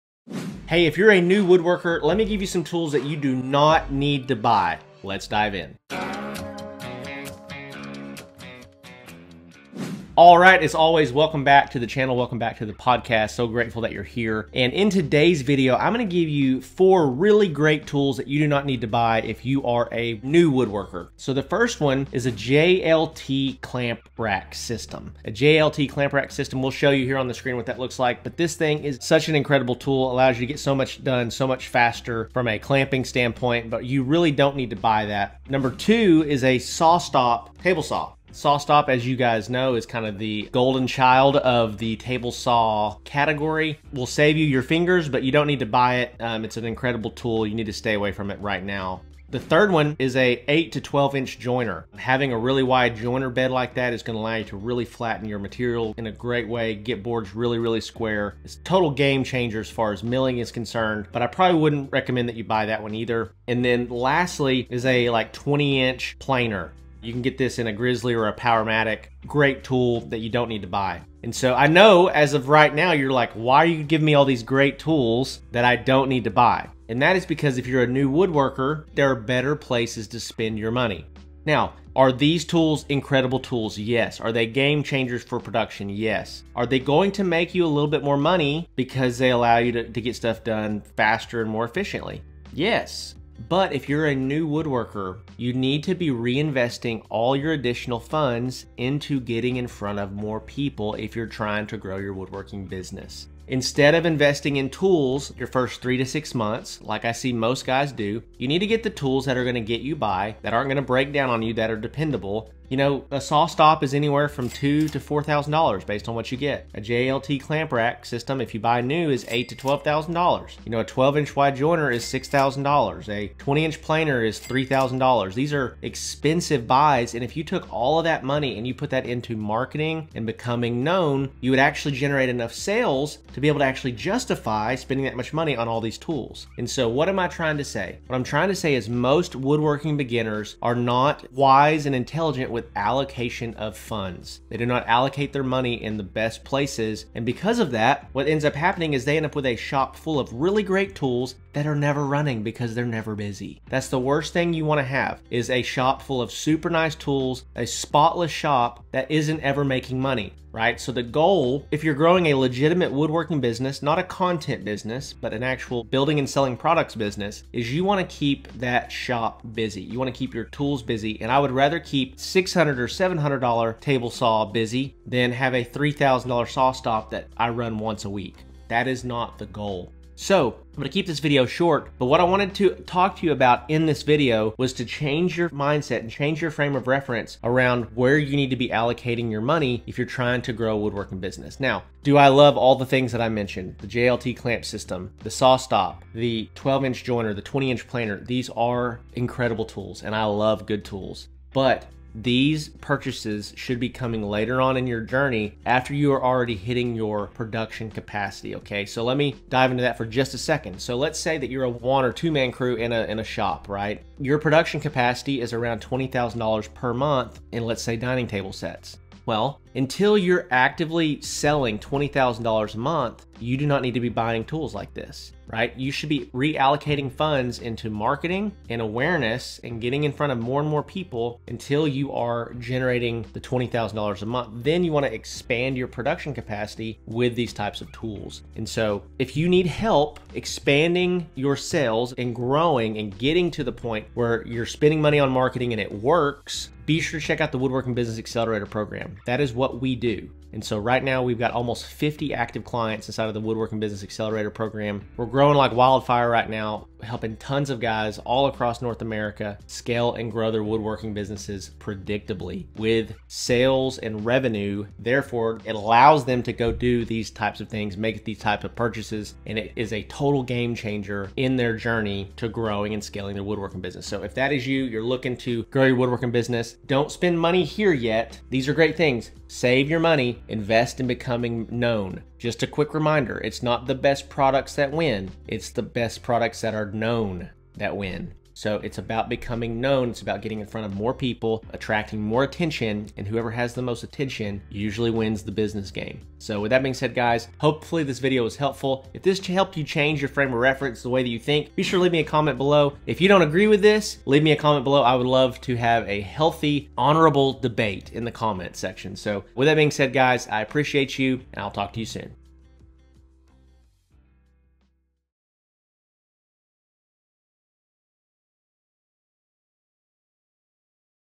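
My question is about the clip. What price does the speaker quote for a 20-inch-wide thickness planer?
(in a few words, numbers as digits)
$3,000.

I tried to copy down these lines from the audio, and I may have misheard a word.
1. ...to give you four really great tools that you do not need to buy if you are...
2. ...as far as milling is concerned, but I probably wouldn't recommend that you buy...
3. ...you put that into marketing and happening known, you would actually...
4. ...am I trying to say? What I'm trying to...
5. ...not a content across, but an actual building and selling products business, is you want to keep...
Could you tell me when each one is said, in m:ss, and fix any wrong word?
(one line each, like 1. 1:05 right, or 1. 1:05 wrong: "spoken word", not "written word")
1. 0:16 right
2. 0:59 right
3. 2:08 wrong: "becoming", not "happening"
4. 2:17 right
5. 2:43 wrong: "business", not "across".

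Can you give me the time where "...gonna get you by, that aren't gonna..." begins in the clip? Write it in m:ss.
1:49.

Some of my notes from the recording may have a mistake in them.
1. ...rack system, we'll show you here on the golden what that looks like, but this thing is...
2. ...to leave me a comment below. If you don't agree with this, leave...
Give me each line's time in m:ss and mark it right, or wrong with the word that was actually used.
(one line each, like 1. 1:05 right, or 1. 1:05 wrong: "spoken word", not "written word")
1. 0:26 wrong: "screen", not "golden"
2. 5:01 right.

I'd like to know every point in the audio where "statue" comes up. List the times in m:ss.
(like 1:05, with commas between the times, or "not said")
not said.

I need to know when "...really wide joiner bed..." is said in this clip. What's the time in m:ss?
0:52.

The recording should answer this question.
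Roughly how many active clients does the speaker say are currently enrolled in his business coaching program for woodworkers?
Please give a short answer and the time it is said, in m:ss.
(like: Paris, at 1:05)
Almost 50, at 4:11.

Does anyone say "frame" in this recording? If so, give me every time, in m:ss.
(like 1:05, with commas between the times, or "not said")
3:06, 5:00.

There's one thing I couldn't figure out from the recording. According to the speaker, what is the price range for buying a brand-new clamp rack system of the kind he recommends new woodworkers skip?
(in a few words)
$8,000 to $12,000.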